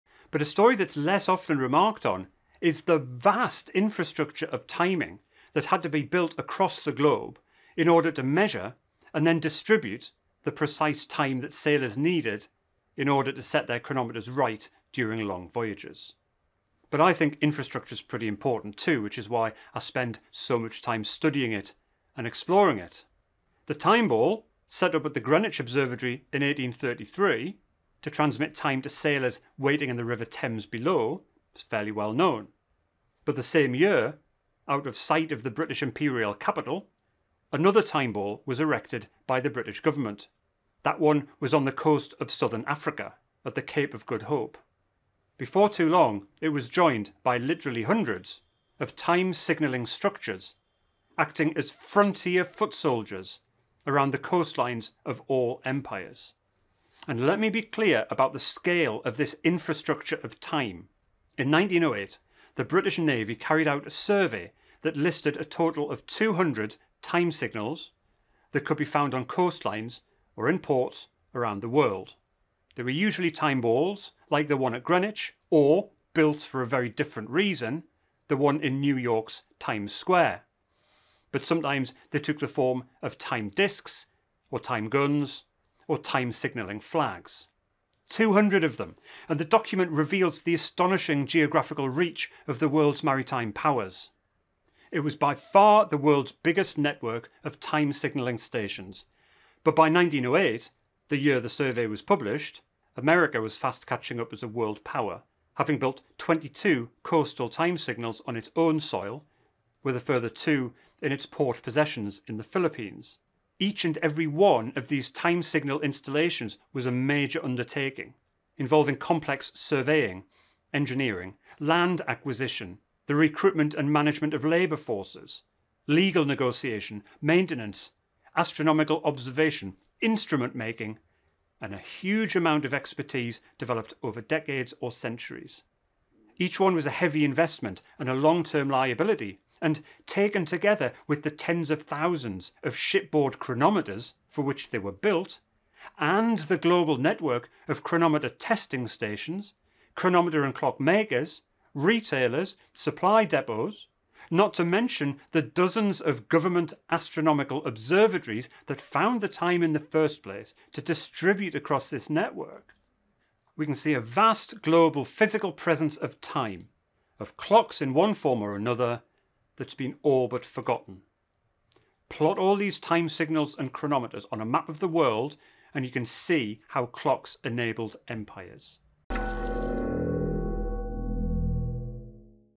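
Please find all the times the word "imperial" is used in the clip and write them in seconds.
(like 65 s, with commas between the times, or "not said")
35 s.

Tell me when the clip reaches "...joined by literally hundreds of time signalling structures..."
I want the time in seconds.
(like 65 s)
46 s.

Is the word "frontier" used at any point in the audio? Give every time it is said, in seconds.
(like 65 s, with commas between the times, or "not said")
51 s.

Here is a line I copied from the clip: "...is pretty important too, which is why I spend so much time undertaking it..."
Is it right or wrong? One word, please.
wrong.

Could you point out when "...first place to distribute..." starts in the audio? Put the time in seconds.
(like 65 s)
159 s.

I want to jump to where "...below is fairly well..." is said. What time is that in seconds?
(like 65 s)
30 s.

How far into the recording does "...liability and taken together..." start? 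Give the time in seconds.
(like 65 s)
138 s.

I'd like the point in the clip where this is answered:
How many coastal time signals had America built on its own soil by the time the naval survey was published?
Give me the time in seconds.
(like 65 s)
106 s.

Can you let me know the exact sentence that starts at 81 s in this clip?
But sometimes they took the form of time discs or time guns or time signalling flags.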